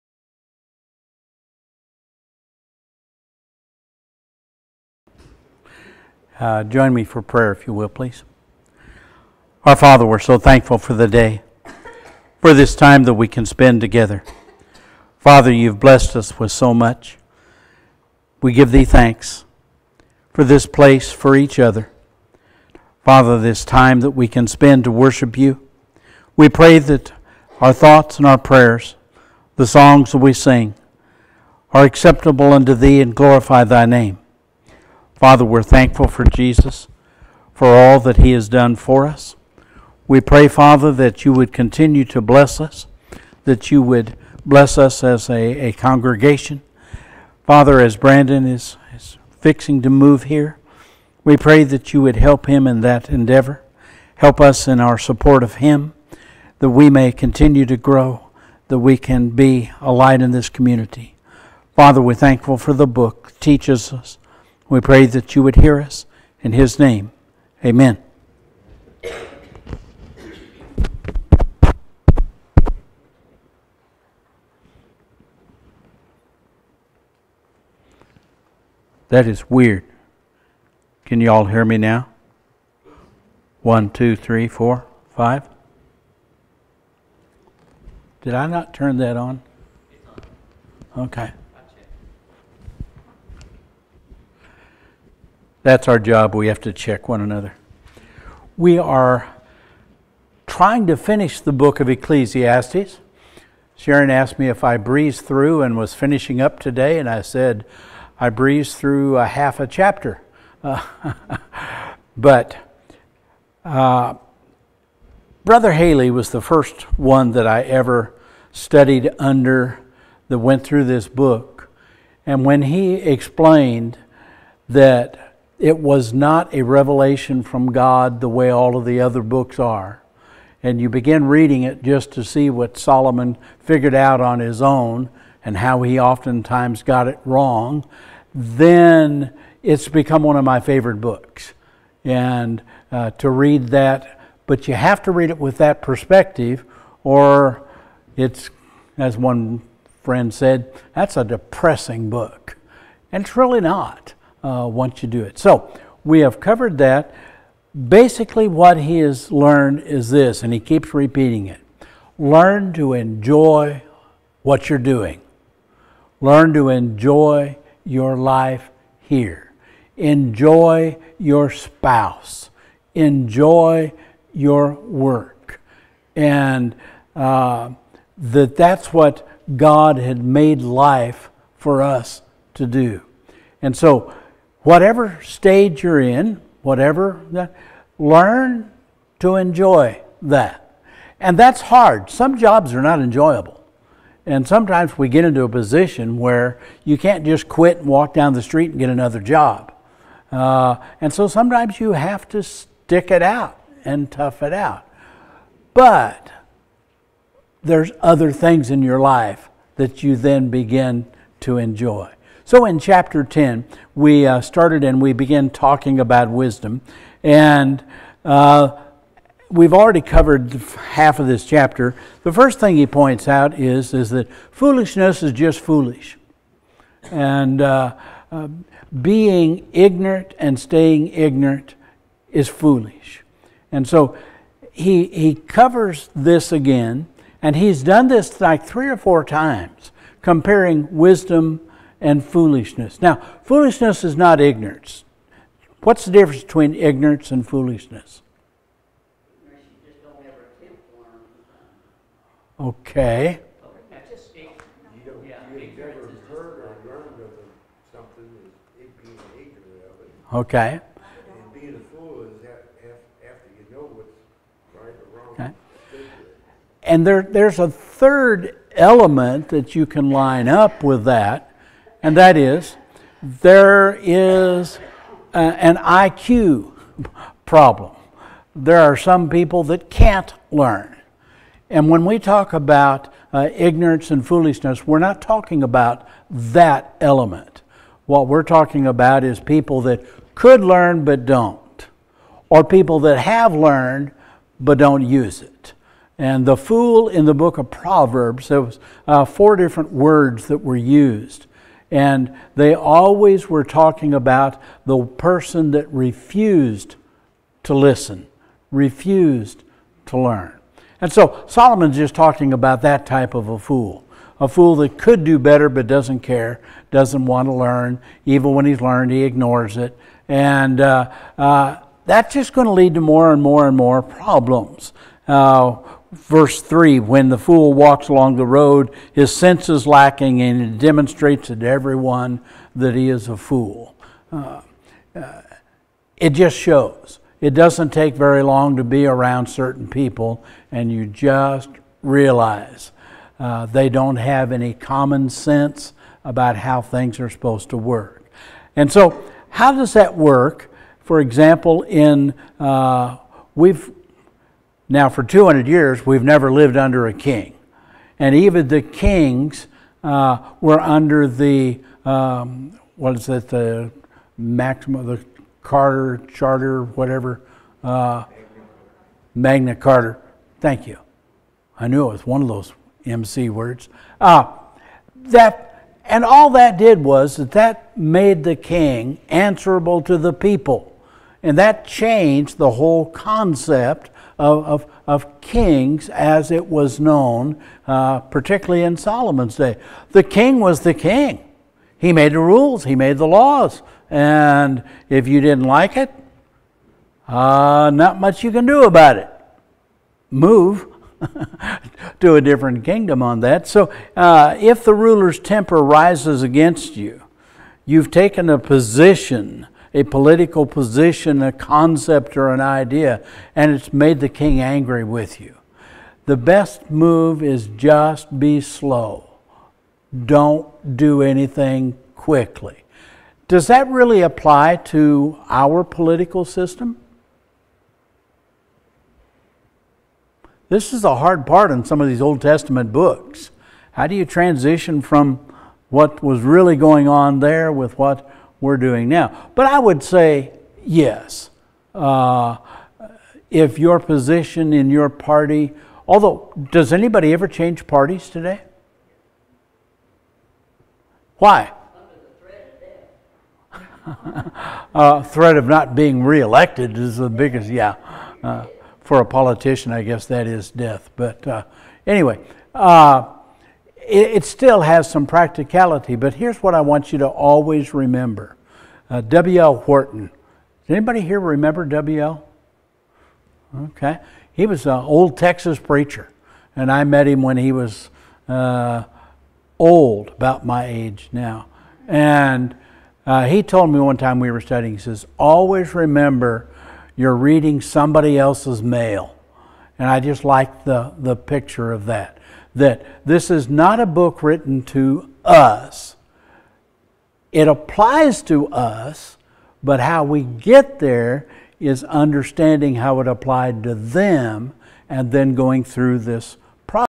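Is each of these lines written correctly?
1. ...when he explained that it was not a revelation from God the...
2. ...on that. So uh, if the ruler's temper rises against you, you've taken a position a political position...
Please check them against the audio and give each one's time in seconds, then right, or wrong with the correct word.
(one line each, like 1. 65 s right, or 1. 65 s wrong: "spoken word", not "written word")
1. 122 s right
2. 403 s right.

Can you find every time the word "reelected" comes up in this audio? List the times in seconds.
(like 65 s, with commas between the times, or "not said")
456 s.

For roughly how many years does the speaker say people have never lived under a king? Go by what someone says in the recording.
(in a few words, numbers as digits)
200.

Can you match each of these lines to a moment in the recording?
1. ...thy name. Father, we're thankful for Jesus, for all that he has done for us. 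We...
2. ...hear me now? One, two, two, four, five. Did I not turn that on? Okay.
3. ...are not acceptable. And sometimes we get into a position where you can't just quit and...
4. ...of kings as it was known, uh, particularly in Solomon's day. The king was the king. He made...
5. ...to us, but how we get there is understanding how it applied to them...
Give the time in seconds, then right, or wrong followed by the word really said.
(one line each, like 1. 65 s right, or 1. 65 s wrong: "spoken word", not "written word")
1. 33 s right
2. 81 s wrong: "three", not "two"
3. 192 s wrong: "enjoyable", not "acceptable"
4. 385 s right
5. 498 s right.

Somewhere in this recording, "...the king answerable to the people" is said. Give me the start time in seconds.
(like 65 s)
378 s.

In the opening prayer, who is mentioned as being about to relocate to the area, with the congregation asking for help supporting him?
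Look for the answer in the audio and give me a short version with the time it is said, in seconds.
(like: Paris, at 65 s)
Brandon, at 47 s.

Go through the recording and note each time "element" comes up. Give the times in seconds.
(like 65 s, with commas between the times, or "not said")
268 s, 286 s.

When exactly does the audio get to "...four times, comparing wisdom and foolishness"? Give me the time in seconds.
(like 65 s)
238 s.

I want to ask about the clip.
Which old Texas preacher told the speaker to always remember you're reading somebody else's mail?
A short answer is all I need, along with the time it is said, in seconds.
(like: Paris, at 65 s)
W.L. Wharton, at 469 s.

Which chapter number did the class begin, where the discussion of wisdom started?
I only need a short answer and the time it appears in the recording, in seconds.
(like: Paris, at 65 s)
10, at 212 s.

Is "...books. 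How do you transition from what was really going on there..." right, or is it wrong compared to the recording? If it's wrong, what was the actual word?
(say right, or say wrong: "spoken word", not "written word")
right.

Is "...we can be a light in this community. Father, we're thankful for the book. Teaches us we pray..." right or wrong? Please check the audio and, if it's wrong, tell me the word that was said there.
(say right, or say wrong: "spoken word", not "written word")
right.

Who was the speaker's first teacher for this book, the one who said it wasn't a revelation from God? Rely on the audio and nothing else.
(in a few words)
Brother Haley.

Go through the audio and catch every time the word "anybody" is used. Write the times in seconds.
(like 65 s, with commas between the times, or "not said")
446 s, 470 s.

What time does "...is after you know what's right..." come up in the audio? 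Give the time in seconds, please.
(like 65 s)
262 s.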